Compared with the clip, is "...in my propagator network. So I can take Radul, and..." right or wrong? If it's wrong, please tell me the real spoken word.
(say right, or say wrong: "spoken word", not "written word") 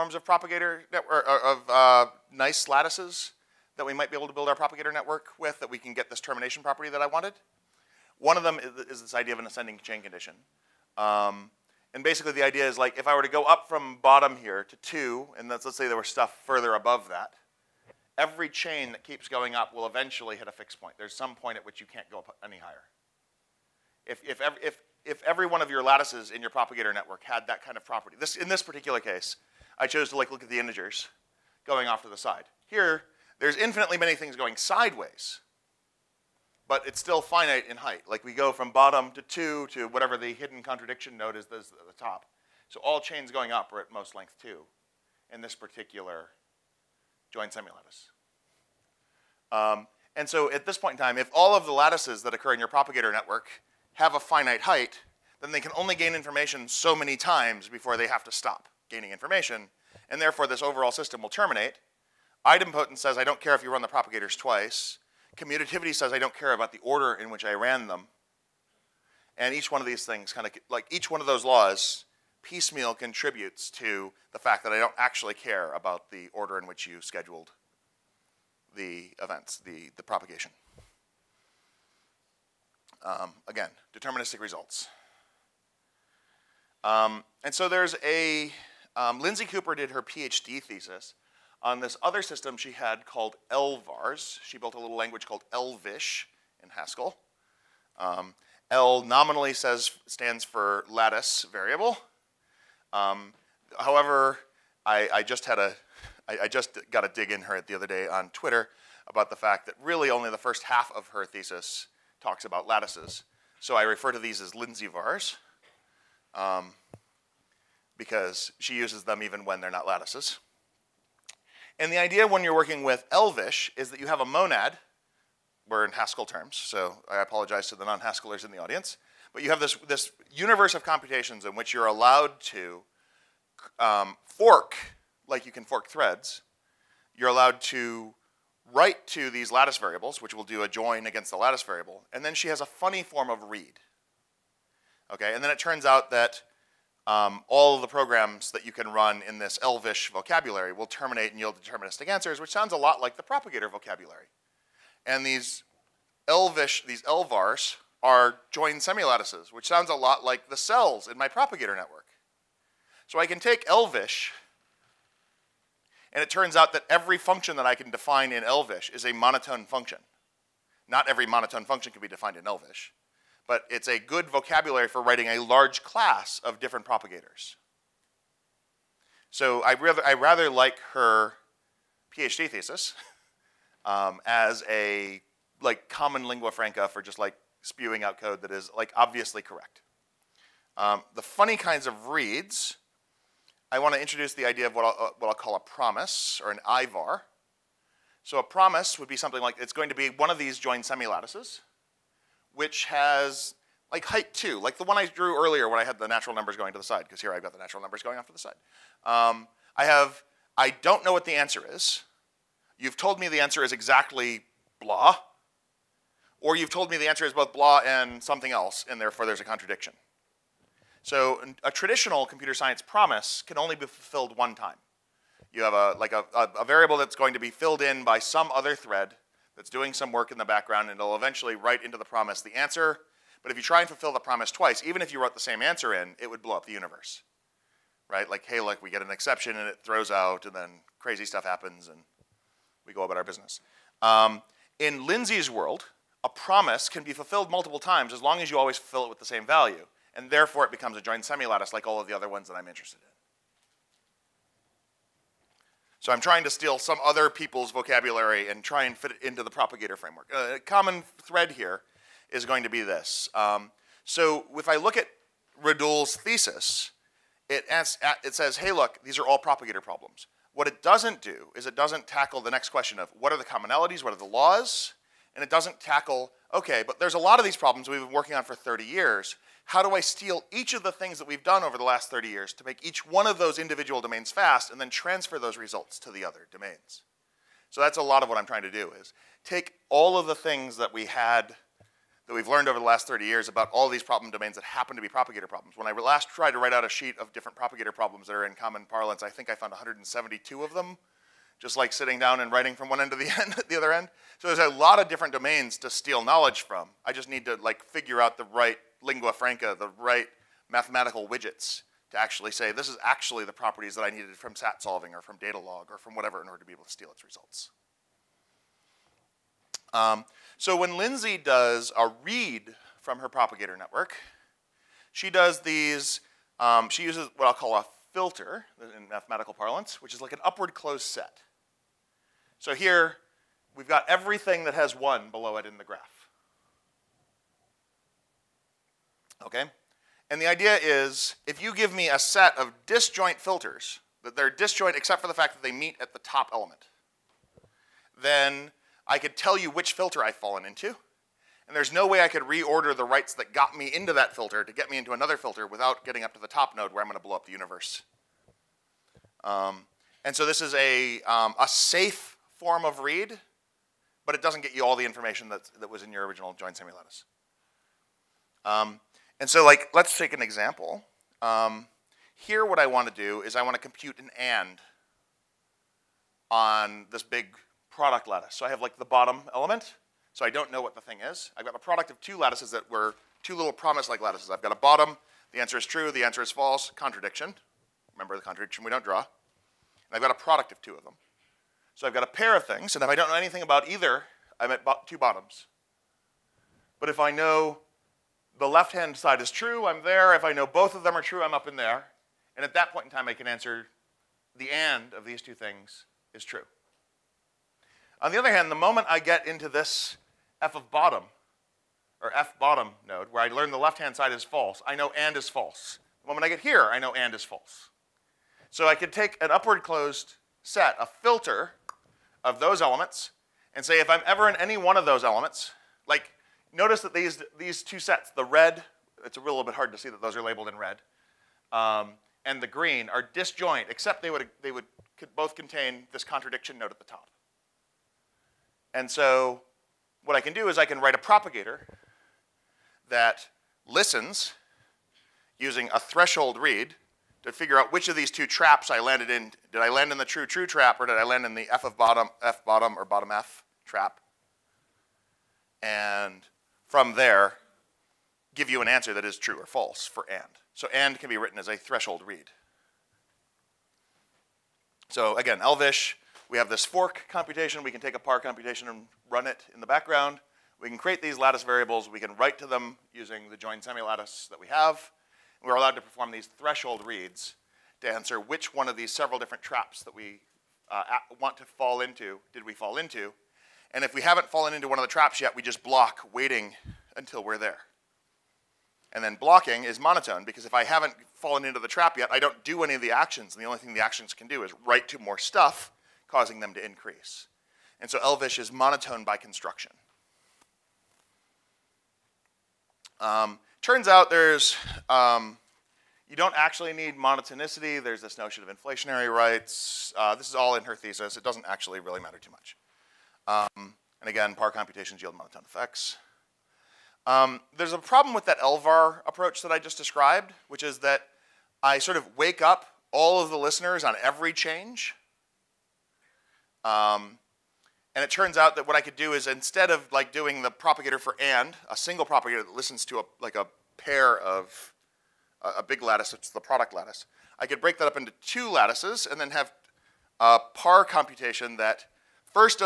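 wrong: "LVish", not "Radul".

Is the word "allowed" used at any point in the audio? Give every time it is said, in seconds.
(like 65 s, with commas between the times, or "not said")
131 s, 137 s, 475 s.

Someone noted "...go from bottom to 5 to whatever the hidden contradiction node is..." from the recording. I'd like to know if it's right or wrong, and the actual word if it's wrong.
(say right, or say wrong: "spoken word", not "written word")
wrong: "2", not "5".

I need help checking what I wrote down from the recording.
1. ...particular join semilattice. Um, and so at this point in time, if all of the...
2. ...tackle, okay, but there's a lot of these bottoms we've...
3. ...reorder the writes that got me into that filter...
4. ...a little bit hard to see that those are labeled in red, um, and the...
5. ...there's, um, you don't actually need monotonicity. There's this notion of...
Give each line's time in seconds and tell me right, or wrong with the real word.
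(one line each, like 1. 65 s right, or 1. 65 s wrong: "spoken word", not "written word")
1. 45 s right
2. 275 s wrong: "problems", not "bottoms"
3. 352 s right
4. 429 s right
5. 504 s right.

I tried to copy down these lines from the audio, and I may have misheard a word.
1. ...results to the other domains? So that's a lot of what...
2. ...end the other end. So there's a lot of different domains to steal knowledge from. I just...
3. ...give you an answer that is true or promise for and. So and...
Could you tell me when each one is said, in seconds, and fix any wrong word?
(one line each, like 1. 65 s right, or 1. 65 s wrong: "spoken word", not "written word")
1. 285 s right
2. 303 s right
3. 458 s wrong: "false", not "promise".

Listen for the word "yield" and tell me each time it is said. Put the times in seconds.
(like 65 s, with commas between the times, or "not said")
151 s, 515 s.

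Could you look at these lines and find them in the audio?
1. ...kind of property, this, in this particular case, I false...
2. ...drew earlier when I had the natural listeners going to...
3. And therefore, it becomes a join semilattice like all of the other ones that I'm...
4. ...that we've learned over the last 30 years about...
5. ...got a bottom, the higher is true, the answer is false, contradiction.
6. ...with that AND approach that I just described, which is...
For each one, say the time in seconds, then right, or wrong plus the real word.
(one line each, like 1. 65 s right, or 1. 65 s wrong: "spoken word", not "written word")
1. 27 s wrong: "chose", not "false"
2. 205 s wrong: "numbers", not "listeners"
3. 250 s right
4. 292 s right
5. 384 s wrong: "answer", not "higher"
6. 518 s wrong: "LVAR", not "AND".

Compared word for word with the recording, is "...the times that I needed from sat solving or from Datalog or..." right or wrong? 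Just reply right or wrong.
wrong.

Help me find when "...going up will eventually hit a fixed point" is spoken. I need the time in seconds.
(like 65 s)
19 s.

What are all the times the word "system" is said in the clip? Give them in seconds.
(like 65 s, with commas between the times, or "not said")
60 s, 92 s.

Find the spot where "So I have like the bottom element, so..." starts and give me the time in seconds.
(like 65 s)
378 s.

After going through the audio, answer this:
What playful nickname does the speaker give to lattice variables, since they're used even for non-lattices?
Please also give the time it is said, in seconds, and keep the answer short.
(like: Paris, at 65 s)
Lindsey vars, at 114 s.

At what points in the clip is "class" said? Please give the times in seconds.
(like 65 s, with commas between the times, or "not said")
175 s.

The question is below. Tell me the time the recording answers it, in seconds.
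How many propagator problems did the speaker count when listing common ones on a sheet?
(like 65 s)
299 s.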